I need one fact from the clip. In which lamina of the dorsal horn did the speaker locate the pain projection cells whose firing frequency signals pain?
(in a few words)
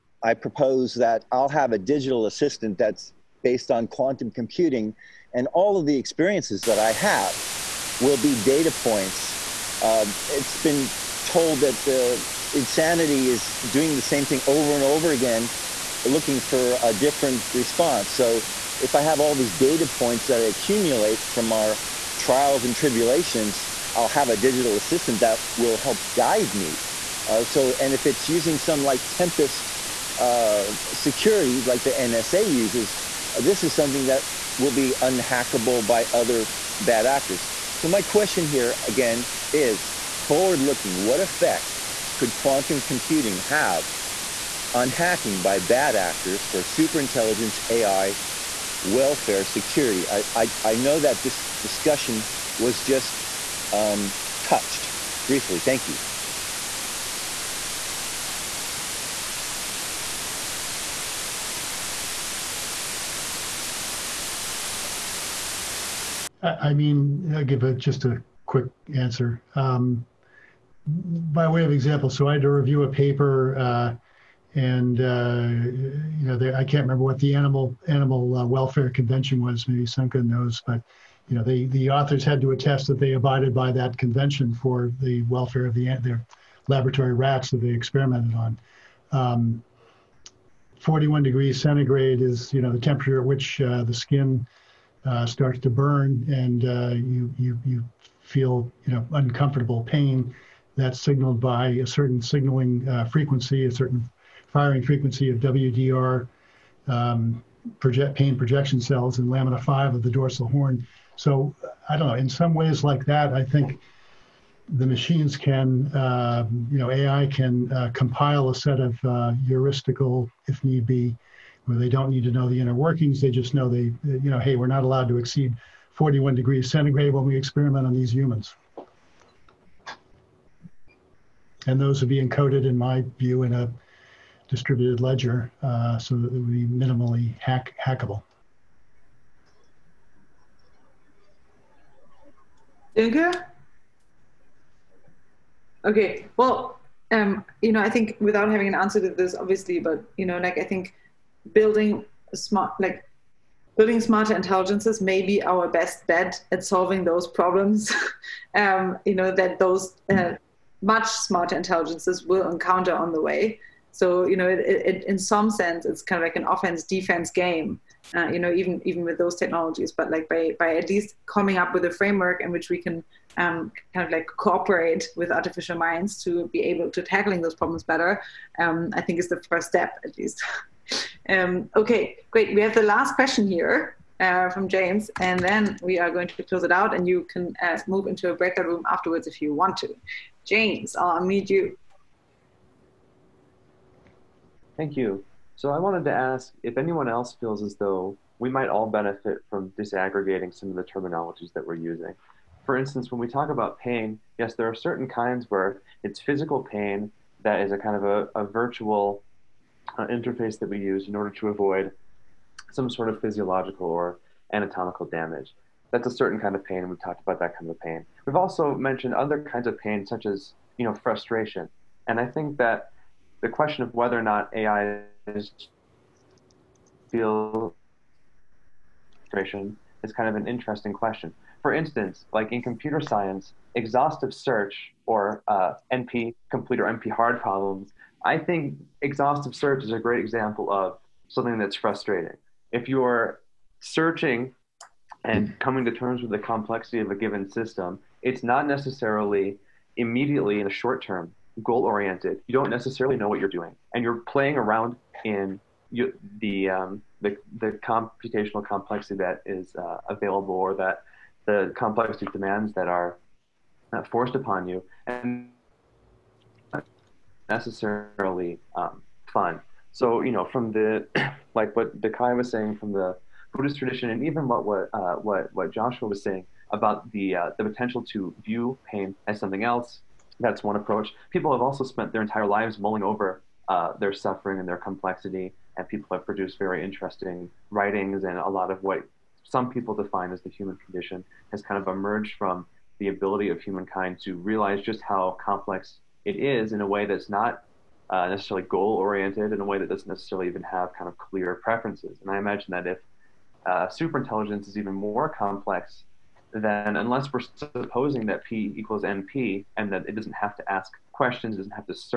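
5.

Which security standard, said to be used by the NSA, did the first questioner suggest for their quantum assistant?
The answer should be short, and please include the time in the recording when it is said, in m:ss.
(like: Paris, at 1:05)
Tempest, at 0:29.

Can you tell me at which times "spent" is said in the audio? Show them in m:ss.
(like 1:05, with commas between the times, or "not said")
4:41.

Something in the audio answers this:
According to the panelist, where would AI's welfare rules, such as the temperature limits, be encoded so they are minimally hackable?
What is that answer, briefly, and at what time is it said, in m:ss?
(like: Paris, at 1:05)
distributed ledger, at 2:14.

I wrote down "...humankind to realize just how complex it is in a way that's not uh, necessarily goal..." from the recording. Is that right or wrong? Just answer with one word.
right.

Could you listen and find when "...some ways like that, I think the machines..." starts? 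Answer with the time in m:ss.
1:52.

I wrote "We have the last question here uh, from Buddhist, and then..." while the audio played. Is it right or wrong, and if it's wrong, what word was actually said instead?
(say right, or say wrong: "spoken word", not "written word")
wrong: "James", not "Buddhist".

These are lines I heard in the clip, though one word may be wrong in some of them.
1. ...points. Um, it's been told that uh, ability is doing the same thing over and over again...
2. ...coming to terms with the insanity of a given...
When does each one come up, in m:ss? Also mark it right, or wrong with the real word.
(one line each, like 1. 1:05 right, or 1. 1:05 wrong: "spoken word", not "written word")
1. 0:08 wrong: "insanity", not "ability"
2. 4:05 wrong: "complexity", not "insanity".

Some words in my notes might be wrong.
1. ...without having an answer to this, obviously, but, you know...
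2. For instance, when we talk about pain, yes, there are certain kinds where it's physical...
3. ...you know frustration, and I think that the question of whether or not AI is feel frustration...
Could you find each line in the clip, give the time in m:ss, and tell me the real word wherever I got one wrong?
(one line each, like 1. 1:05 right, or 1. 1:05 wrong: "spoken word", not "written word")
1. 2:28 right
2. 3:22 right
3. 3:40 right.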